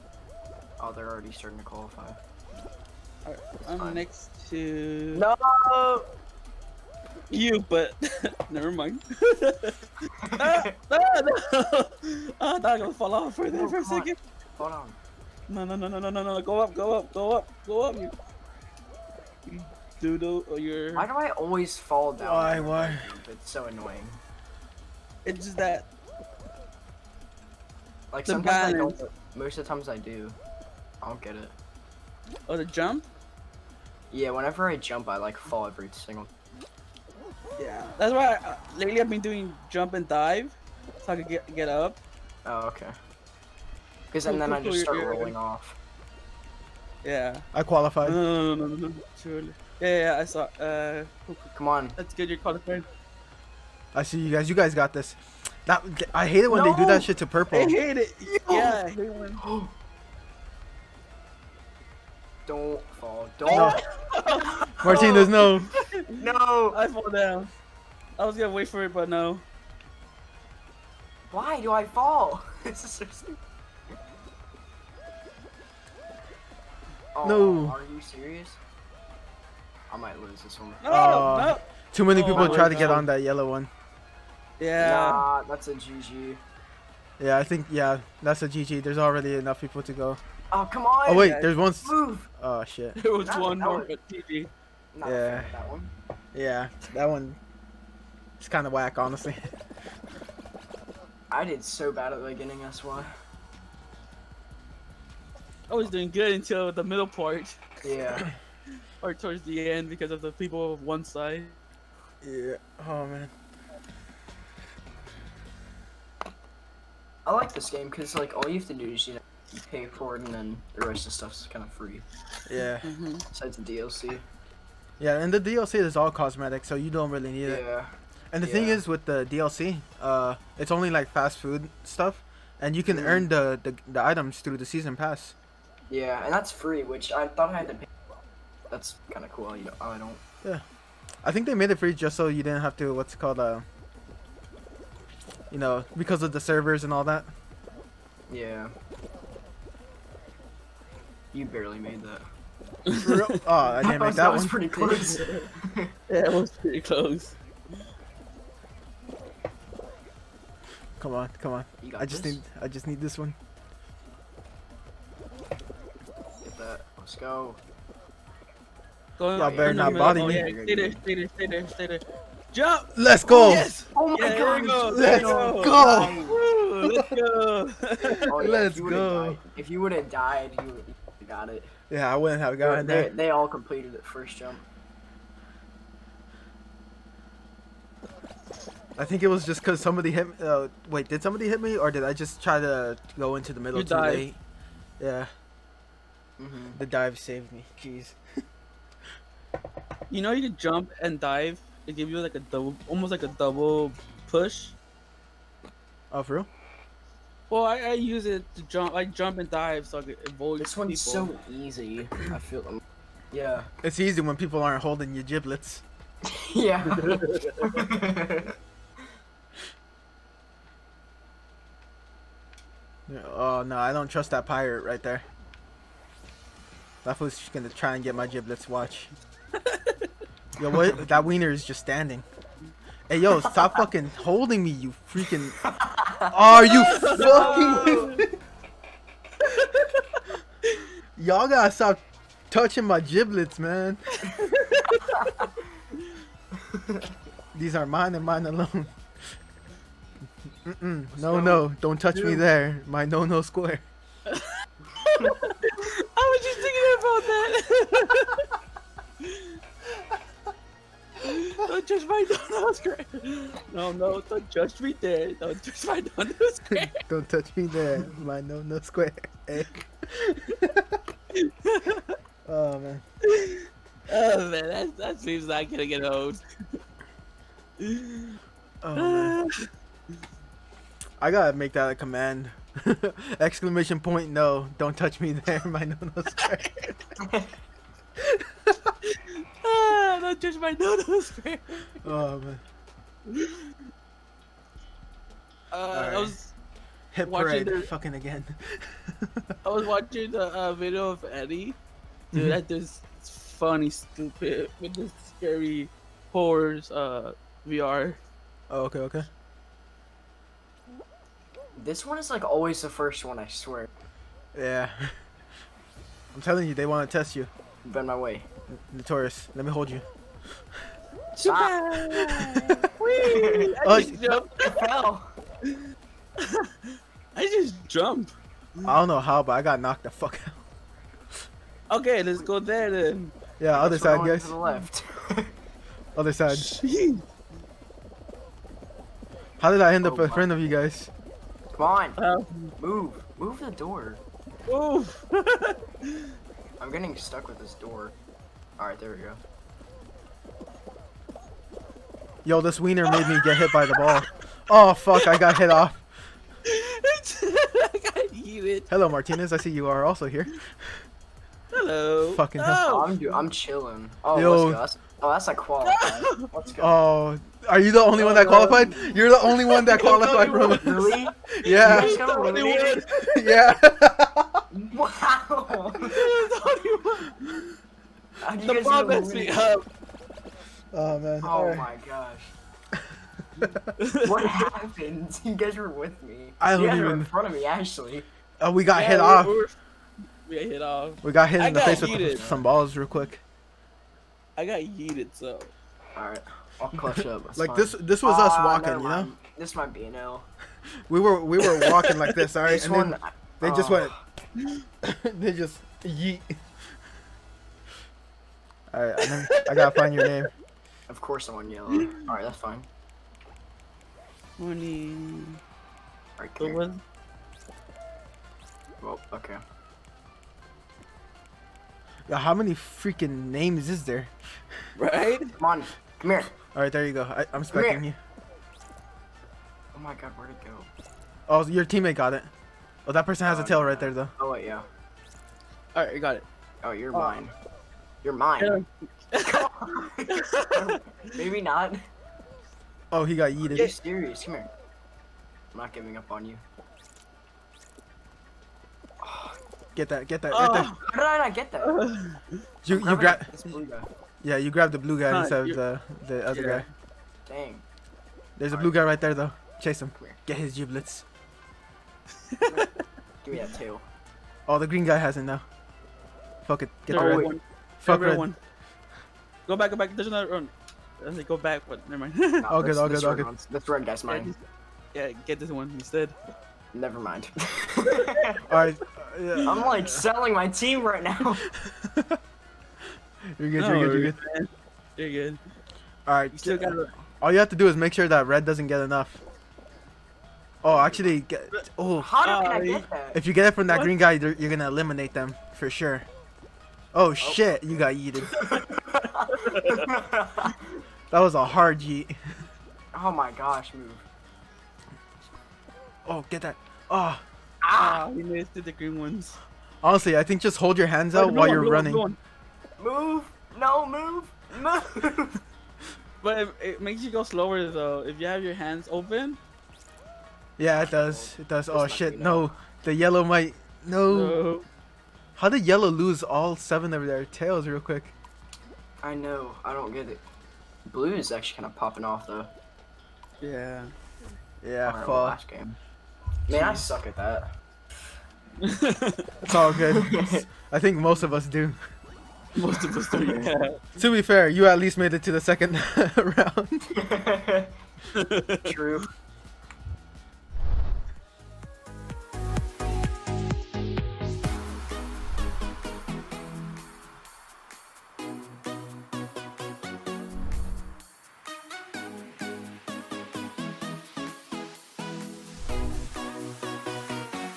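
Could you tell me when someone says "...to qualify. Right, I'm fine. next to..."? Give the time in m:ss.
0:01.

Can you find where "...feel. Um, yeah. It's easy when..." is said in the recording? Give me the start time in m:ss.
3:32.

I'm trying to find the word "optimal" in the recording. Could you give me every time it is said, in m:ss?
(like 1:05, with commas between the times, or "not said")
not said.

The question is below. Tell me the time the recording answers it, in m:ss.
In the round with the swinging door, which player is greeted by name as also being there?
5:59.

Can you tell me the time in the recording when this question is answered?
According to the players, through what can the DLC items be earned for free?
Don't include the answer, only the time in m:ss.
2:14.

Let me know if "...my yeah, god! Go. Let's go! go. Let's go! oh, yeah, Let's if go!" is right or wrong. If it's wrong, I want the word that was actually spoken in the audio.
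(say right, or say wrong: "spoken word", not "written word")
right.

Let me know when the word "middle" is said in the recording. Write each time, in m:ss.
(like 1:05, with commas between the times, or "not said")
1:46, 3:13.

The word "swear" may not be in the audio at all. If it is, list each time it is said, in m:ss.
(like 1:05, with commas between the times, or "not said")
5:13.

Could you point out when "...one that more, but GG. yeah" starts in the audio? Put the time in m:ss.
1:33.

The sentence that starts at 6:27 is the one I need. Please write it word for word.
were in front of me actually.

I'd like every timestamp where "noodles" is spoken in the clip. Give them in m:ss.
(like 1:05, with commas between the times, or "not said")
4:50.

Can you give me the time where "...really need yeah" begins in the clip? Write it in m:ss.
2:07.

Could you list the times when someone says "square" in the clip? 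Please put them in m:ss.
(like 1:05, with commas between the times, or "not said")
4:13, 4:28, 4:46.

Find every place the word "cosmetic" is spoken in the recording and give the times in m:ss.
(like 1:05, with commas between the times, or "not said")
2:06.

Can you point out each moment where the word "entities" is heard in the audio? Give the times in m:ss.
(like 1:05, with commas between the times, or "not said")
not said.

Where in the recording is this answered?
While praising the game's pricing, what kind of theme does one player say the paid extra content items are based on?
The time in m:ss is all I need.
2:11.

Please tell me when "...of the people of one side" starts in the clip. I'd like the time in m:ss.
1:50.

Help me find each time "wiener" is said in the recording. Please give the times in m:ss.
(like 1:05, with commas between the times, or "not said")
3:51, 5:52.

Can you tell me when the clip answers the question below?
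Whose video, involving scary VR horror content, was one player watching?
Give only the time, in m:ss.
5:01.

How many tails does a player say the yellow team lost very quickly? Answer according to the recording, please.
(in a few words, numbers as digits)
7.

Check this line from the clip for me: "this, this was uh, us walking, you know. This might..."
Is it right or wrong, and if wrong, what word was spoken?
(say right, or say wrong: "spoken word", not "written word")
right.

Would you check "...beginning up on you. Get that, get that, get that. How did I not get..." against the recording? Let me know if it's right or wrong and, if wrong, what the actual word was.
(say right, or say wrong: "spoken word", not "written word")
wrong: "giving", not "beginning".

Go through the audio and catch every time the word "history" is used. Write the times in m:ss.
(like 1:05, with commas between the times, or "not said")
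not said.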